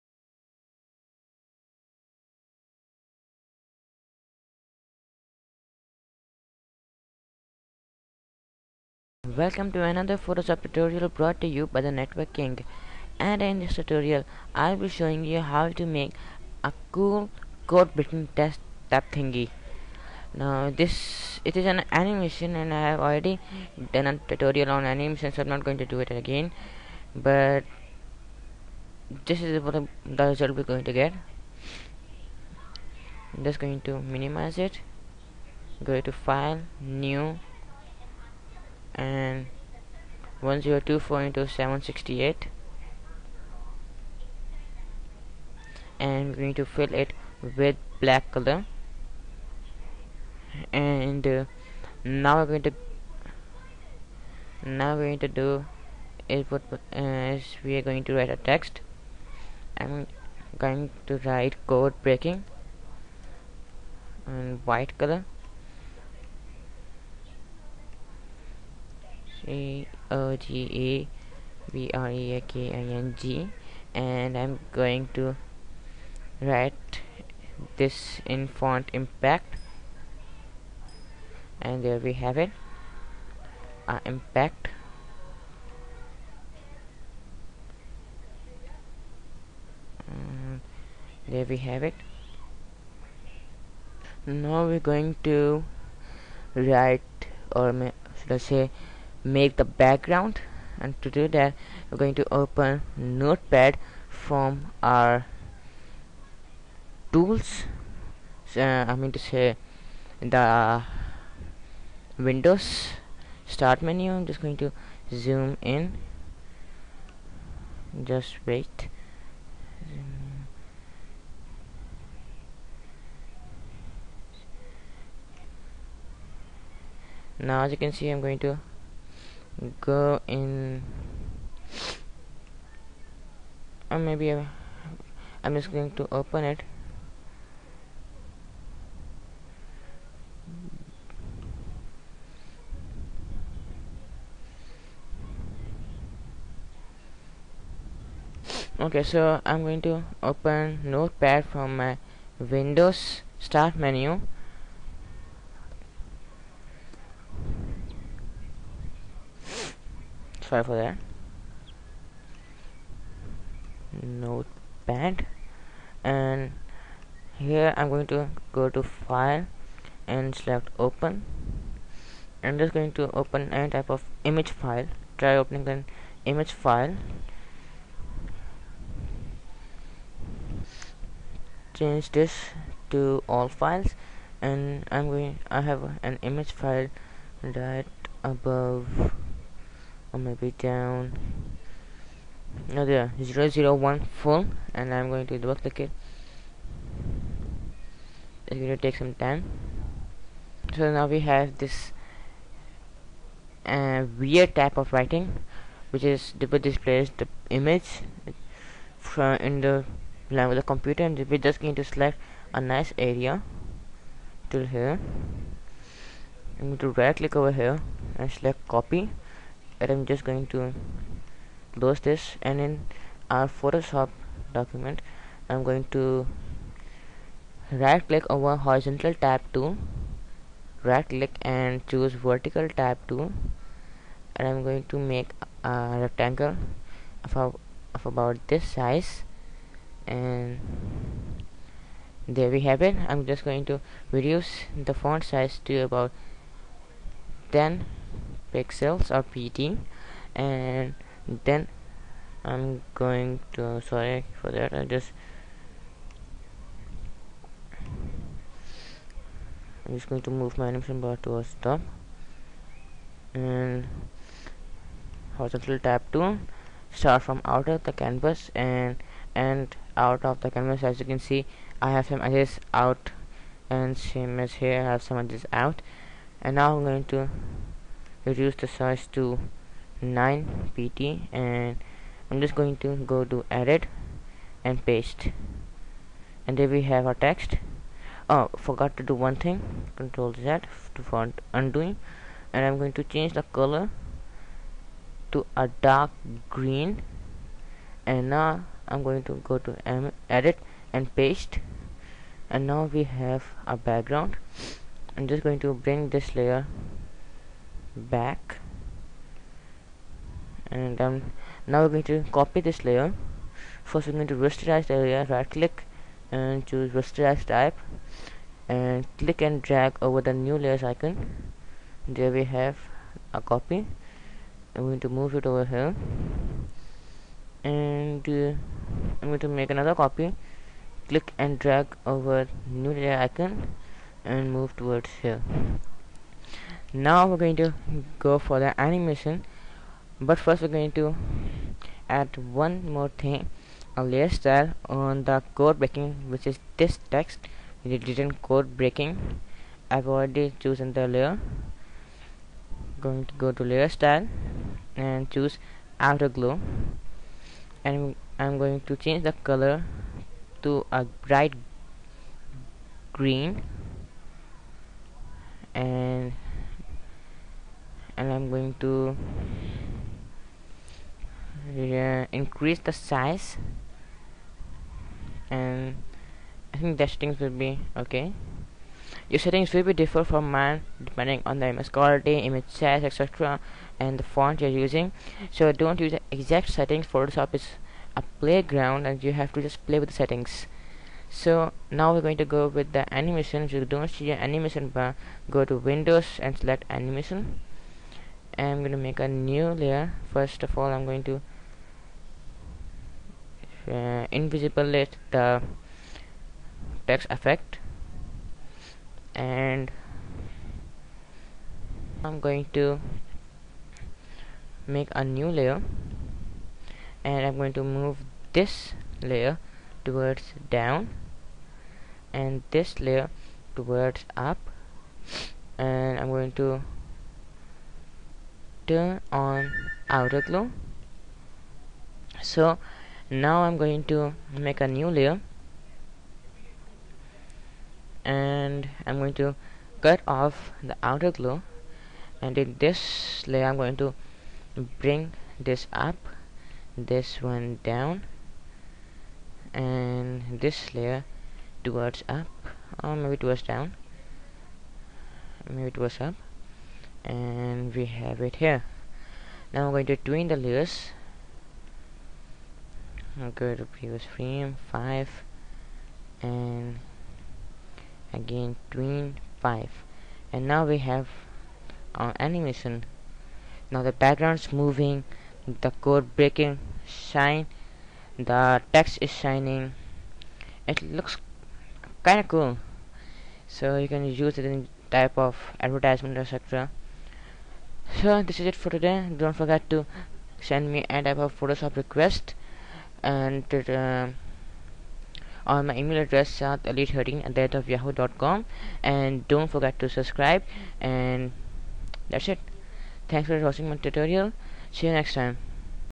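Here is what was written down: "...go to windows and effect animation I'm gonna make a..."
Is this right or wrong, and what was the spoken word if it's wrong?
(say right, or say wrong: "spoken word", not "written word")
wrong: "select", not "effect".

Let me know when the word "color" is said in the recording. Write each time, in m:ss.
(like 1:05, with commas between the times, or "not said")
0:48, 1:04, 4:53, 5:59.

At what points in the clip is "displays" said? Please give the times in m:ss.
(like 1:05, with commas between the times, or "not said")
3:26.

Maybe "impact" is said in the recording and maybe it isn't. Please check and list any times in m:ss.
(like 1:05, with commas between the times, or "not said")
1:18, 1:24.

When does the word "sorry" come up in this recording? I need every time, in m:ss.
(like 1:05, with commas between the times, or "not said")
2:40, 4:13.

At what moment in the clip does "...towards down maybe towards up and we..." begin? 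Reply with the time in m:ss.
7:33.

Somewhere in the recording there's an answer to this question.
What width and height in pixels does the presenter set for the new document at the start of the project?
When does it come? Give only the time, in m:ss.
0:40.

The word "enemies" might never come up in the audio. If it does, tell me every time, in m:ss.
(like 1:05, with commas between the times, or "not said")
not said.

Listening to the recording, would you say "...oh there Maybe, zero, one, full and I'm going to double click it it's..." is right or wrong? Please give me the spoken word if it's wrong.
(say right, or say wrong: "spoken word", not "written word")
wrong: "Zero", not "Maybe".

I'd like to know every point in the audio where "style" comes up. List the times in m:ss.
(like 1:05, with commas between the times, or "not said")
5:44, 5:53.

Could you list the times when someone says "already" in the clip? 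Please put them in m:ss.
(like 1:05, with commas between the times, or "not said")
0:22, 5:50.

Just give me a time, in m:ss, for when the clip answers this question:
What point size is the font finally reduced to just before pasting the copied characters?
4:39.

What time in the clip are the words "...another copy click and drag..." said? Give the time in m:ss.
5:29.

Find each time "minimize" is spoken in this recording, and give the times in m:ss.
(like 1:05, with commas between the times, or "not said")
0:34.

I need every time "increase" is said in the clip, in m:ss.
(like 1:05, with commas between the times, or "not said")
6:12.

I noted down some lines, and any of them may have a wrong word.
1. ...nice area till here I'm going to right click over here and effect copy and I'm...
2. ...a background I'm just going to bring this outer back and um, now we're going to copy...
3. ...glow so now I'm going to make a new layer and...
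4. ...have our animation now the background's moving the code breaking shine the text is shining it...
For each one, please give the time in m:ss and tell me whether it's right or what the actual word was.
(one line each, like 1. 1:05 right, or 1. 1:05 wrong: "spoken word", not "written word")
1. 3:32 wrong: "select", not "effect"
2. 5:03 wrong: "layer", not "outer"
3. 7:10 right
4. 7:50 right.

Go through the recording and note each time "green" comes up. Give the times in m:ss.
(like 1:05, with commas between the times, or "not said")
4:56, 6:03.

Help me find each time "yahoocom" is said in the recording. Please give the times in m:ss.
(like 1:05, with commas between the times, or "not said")
8:17.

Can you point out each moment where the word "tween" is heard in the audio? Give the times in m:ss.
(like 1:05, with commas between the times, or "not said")
7:40, 7:48.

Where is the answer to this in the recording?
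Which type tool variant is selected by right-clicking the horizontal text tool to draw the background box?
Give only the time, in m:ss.
3:52.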